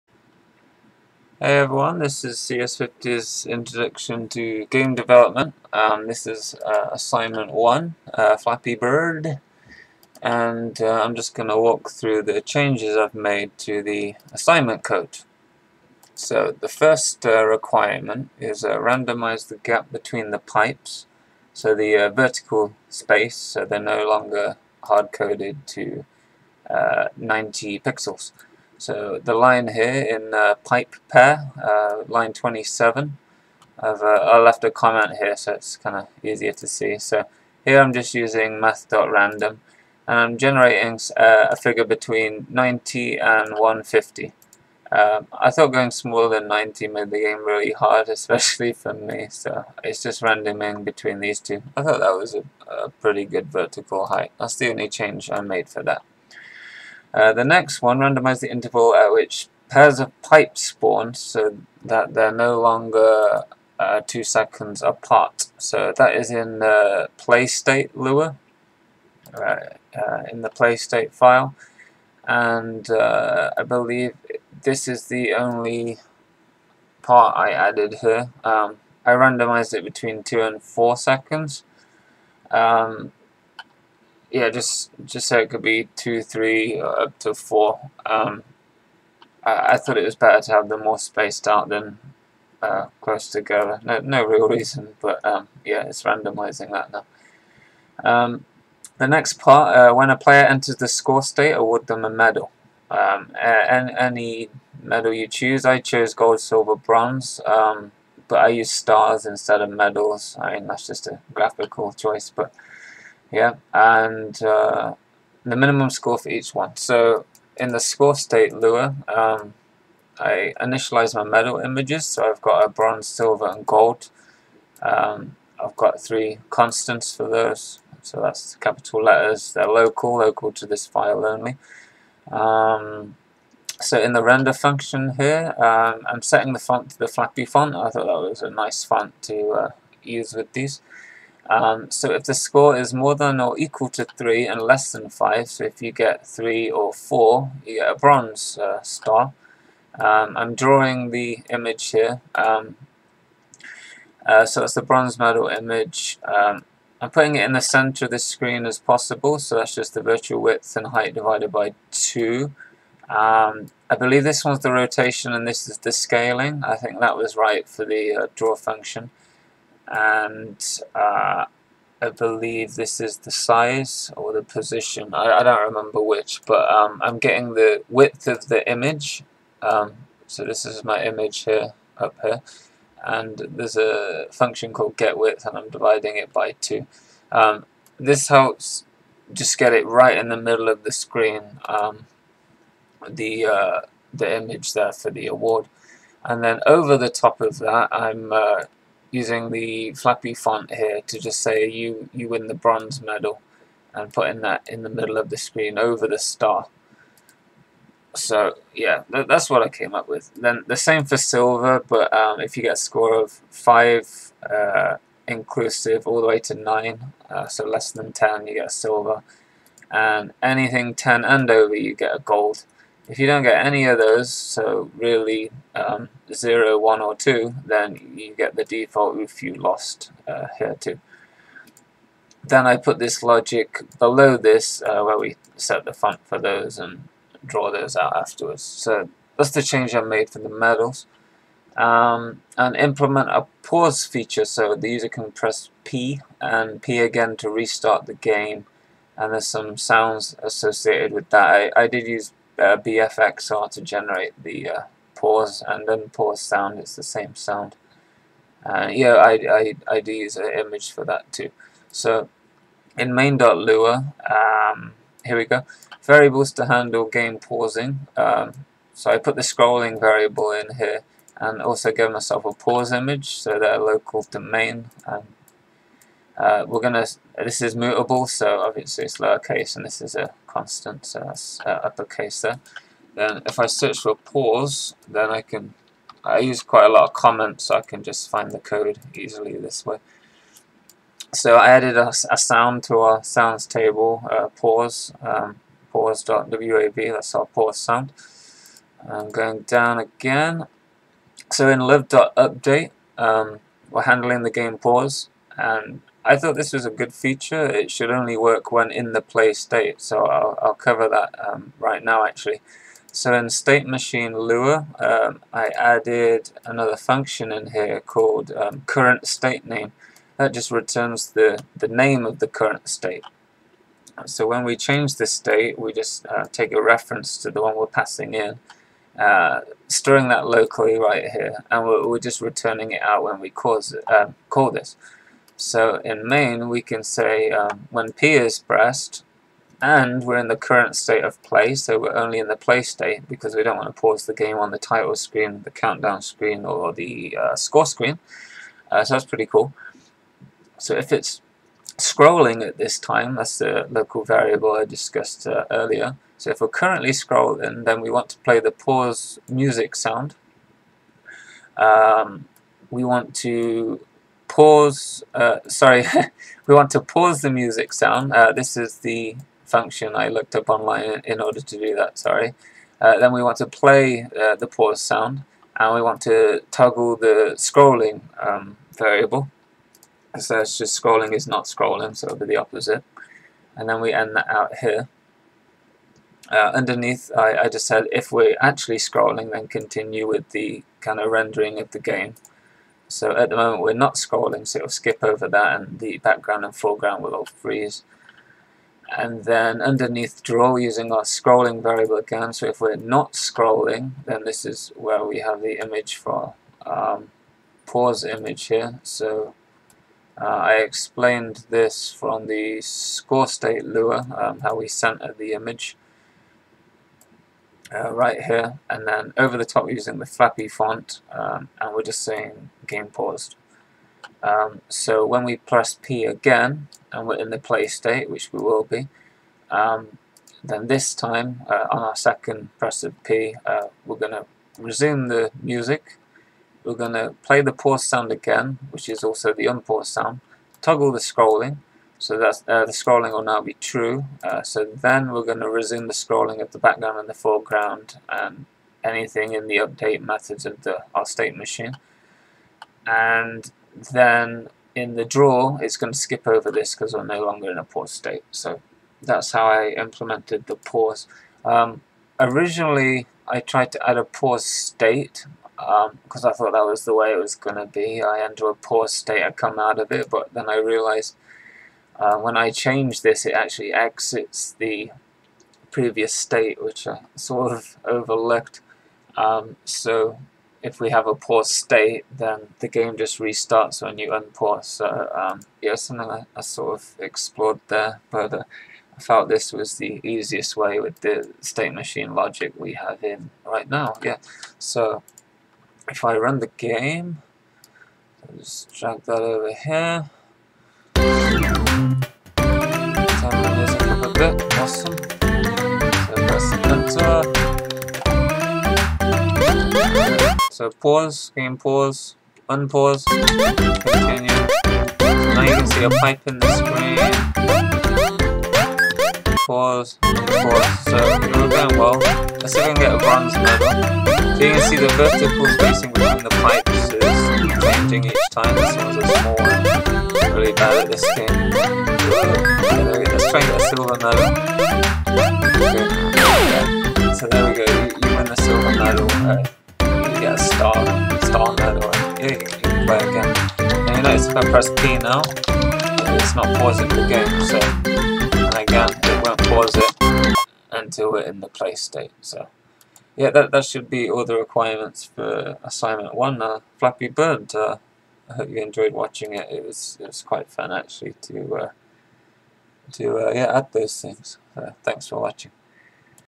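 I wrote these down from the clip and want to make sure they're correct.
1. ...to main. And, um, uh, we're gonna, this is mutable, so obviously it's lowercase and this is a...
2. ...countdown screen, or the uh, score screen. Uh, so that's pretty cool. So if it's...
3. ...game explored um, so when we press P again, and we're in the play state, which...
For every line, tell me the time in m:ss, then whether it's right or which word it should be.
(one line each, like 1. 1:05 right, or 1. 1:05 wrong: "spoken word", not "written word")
1. 4:34 right
2. 5:45 right
3. 7:02 wrong: "paused", not "explored".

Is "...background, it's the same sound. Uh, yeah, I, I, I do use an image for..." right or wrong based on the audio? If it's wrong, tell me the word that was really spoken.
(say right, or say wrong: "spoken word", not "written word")
wrong: "sound", not "background".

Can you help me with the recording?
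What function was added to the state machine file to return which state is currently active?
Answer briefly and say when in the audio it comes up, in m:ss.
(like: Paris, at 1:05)
current state name, at 5:18.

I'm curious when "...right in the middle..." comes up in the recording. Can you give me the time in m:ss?
3:09.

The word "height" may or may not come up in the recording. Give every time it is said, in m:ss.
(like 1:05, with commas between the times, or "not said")
0:54, 2:40.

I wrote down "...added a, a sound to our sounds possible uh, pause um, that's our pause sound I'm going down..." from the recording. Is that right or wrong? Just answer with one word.
wrong.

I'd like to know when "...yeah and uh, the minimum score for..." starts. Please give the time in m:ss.
1:53.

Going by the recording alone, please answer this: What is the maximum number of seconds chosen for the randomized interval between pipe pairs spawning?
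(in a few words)
4.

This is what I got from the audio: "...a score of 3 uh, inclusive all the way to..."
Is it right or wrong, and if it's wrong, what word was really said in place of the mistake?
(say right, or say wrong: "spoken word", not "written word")
wrong: "5", not "3".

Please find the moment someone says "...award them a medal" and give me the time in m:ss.
1:41.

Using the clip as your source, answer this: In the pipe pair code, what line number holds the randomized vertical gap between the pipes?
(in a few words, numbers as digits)
27.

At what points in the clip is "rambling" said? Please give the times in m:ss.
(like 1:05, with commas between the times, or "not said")
not said.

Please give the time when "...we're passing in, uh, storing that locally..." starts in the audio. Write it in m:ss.
5:27.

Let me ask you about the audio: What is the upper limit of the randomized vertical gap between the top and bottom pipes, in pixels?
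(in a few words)
150.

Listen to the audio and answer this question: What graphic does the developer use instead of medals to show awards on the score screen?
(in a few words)
Stars.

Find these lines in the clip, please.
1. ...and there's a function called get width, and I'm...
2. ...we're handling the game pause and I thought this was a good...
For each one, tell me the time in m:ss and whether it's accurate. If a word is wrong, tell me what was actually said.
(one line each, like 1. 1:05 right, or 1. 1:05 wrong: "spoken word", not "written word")
1. 3:03 right
2. 5:03 right.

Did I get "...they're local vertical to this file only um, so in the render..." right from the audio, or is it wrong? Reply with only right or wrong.
wrong.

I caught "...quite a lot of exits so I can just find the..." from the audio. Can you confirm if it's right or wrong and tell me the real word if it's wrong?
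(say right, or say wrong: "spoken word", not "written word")
wrong: "comments", not "exits".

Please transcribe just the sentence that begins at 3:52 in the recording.
Then I put this logic below this uh, where we set the font for those and draw those out afterwards.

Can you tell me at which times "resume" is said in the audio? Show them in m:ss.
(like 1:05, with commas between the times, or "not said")
7:14, 7:25.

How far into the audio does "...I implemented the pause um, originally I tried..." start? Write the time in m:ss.
7:39.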